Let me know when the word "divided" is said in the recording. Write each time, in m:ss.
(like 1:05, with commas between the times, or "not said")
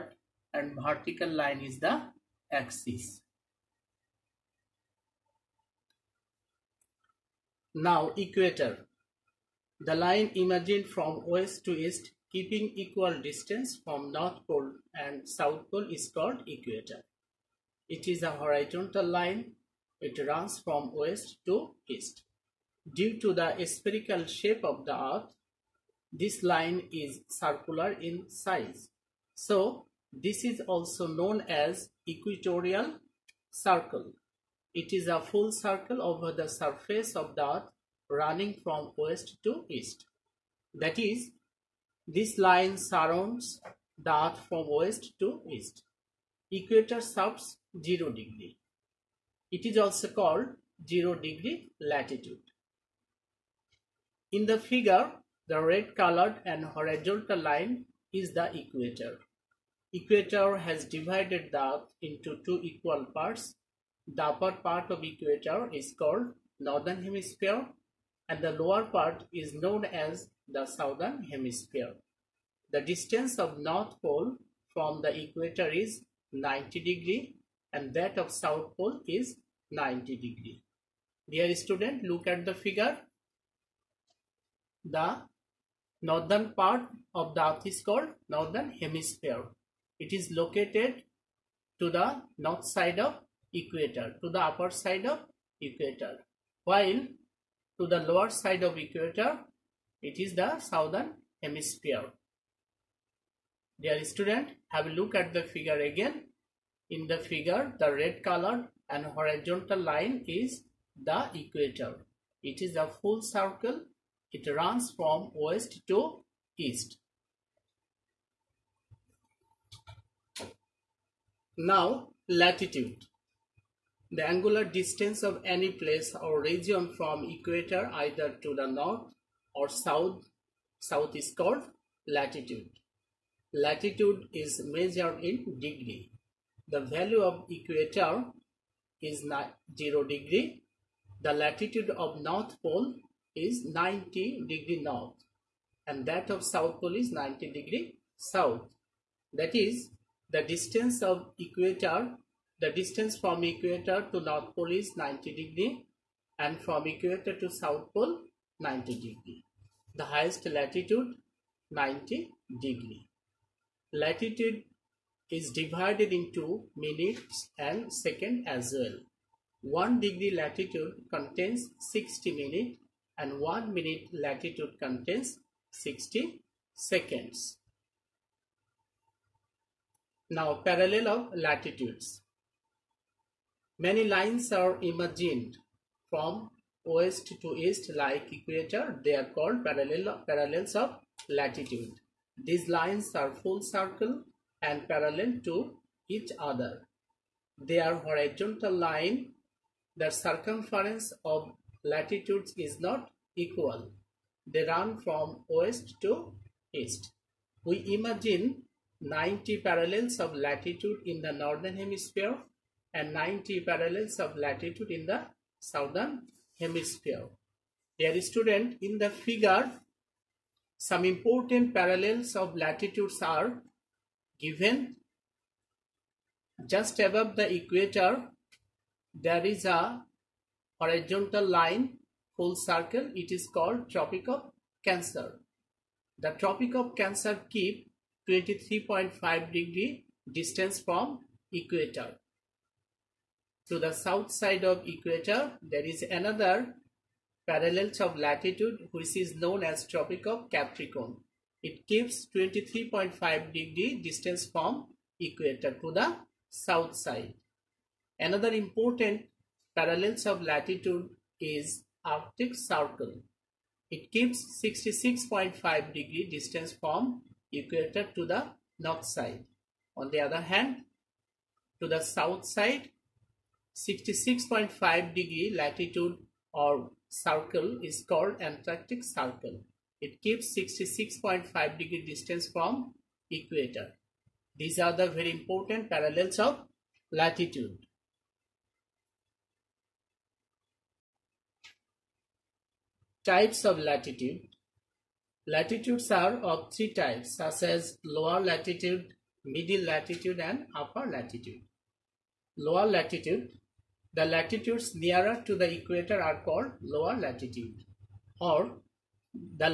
1:00, 2:45.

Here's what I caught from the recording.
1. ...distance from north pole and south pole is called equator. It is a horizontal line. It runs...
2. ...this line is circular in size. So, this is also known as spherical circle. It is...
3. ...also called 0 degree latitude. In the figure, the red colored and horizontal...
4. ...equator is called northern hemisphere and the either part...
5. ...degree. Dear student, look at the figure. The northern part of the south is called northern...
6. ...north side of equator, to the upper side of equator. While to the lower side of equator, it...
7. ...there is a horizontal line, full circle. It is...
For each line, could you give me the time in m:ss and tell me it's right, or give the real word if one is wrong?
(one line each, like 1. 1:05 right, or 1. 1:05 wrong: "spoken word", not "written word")
1. 0:13 right
2. 0:26 wrong: "equatorial", not "spherical"
3. 0:49 right
4. 1:05 wrong: "lower", not "either"
5. 1:20 wrong: "earth", not "south"
6. 1:32 right
7. 3:49 right.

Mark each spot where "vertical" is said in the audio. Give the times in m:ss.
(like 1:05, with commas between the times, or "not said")
0:00.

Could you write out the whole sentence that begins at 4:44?
These are the very important parallels of latitude.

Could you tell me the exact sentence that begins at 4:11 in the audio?
It gives 23.5 degree distance from equator to the south side.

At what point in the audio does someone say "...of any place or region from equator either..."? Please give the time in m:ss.
2:05.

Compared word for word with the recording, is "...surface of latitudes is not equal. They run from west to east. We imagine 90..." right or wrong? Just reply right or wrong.
wrong.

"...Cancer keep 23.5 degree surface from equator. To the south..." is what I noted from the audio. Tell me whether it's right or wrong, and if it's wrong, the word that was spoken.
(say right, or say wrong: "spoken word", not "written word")
wrong: "distance", not "surface".